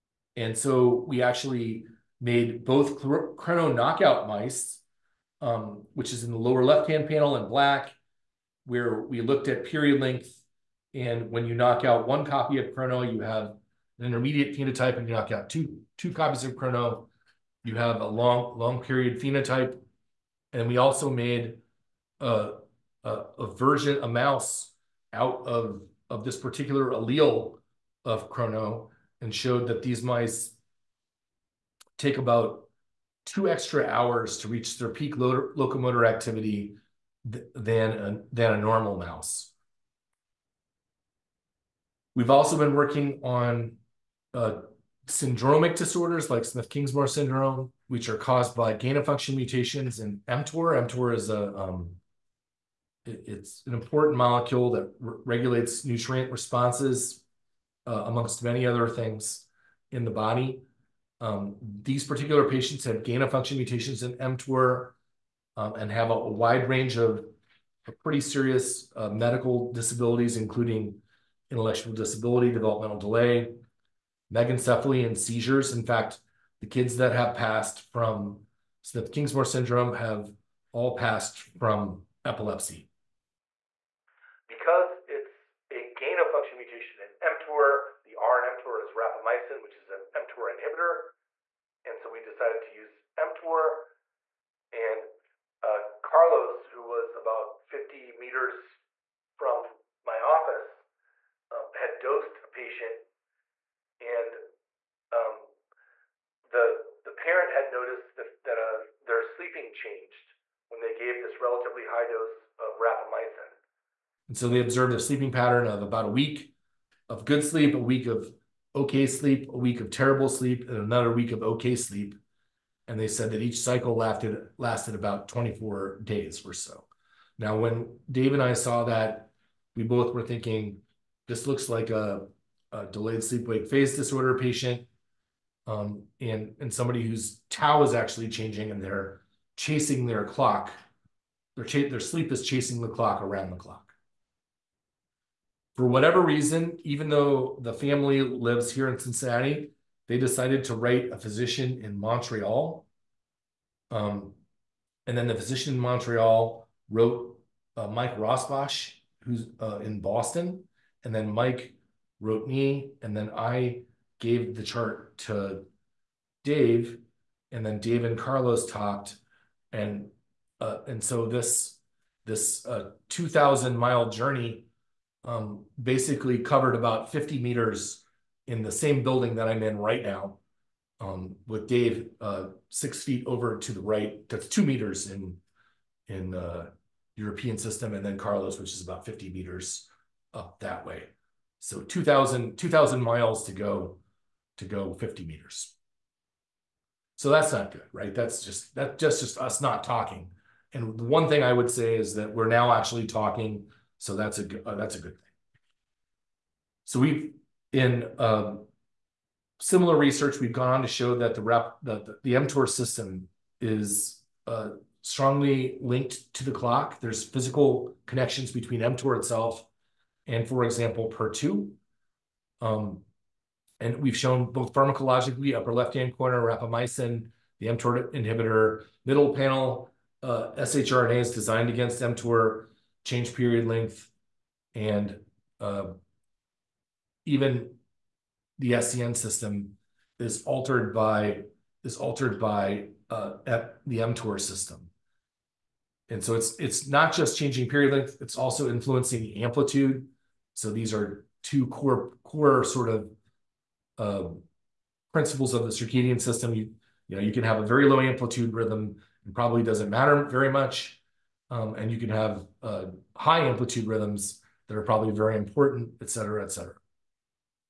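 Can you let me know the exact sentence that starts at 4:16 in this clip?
You, you know, you can have a very low amplitude rhythm and probably doesn't matter very much.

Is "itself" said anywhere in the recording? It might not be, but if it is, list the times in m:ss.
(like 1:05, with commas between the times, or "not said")
3:39.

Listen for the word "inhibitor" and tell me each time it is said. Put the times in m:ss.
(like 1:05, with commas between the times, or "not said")
1:30, 3:48.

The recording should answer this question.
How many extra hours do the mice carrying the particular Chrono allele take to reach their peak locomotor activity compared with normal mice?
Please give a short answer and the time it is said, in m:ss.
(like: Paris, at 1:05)
2, at 0:33.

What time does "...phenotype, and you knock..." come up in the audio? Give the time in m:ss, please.
0:14.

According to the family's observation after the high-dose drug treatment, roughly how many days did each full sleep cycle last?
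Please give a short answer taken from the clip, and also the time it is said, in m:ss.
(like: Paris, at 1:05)
24 days, at 2:05.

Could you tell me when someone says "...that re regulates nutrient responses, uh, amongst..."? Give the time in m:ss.
0:54.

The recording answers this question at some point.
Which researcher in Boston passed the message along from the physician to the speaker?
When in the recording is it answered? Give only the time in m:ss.
2:37.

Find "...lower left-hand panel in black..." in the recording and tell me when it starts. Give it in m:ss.
0:06.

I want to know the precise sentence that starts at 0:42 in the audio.
We've also been working on uh, syndromic disorders like Smith-Kingsmore syndrome, which are caused by gain-of-function mutations in mTOR.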